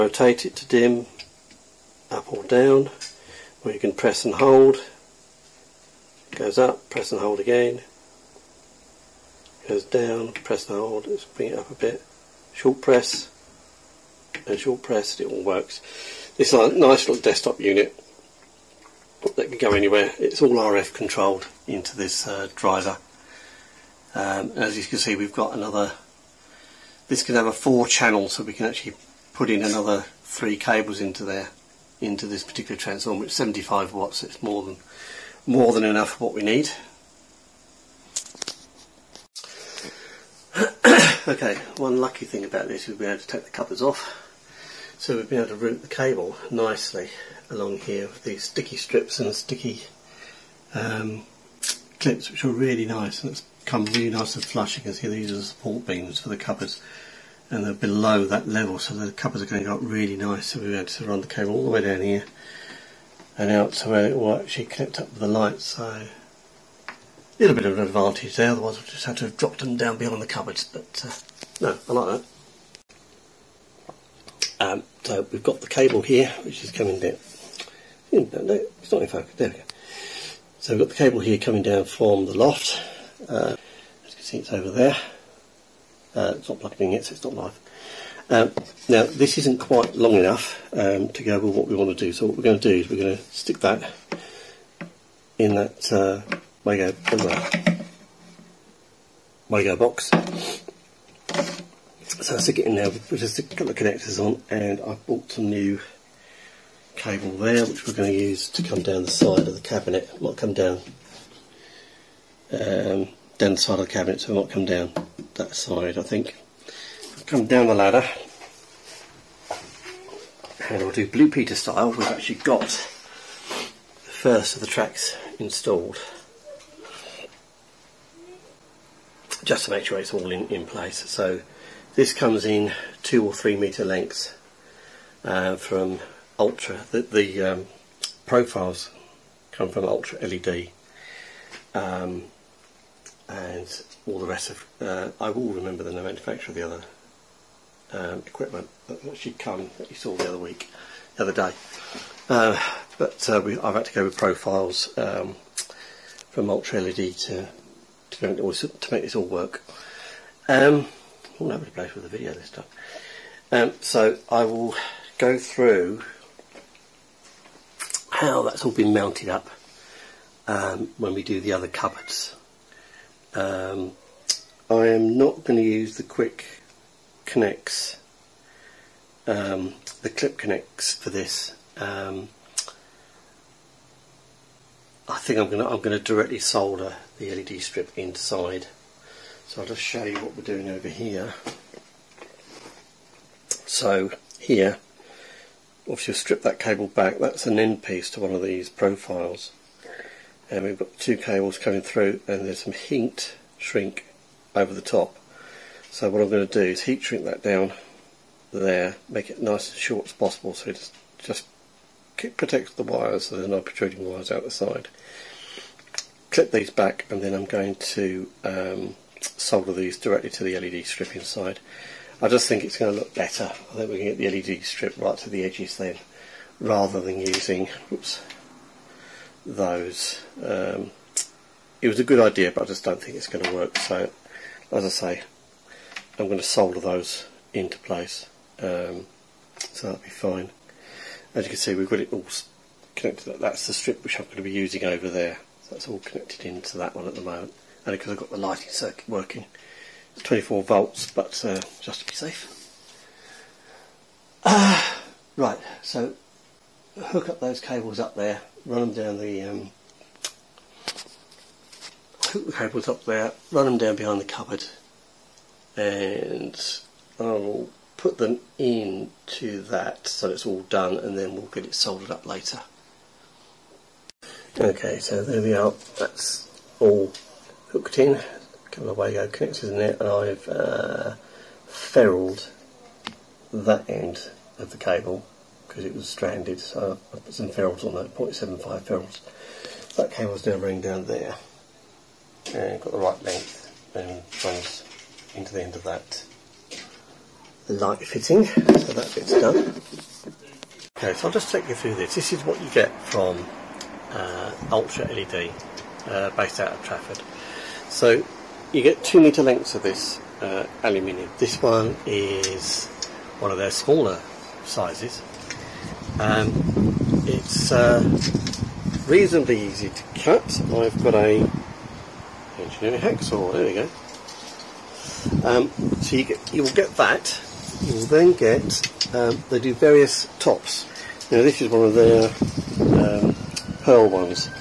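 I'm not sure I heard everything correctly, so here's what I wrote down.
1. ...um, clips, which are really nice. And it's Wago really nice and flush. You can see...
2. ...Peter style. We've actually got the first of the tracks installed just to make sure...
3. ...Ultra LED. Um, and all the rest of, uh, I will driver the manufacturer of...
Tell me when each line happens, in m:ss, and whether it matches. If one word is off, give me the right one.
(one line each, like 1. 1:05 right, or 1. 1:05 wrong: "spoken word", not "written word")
1. 0:50 wrong: "Come", not "Wago"
2. 2:01 right
3. 2:19 wrong: "remember", not "driver".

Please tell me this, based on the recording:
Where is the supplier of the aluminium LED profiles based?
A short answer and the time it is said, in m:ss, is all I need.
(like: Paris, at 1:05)
Trafford, at 5:06.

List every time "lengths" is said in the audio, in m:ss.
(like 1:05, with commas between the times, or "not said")
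2:13, 4:53, 5:09.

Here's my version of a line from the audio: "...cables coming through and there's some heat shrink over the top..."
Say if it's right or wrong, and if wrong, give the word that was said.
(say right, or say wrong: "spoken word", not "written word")
right.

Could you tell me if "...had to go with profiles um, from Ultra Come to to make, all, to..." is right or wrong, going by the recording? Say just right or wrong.
wrong.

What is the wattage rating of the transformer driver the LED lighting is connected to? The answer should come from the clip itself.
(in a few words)
75 watts.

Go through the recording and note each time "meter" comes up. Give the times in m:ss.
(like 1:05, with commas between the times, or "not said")
2:13.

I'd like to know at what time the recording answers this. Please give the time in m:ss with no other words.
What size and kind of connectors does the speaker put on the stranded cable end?
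4:48.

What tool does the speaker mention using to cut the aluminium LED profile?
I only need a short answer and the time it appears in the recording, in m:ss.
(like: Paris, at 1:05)
engineering hacksaw, at 5:22.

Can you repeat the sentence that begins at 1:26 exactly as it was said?
Uh, it's not plugged in yet, so it's not live.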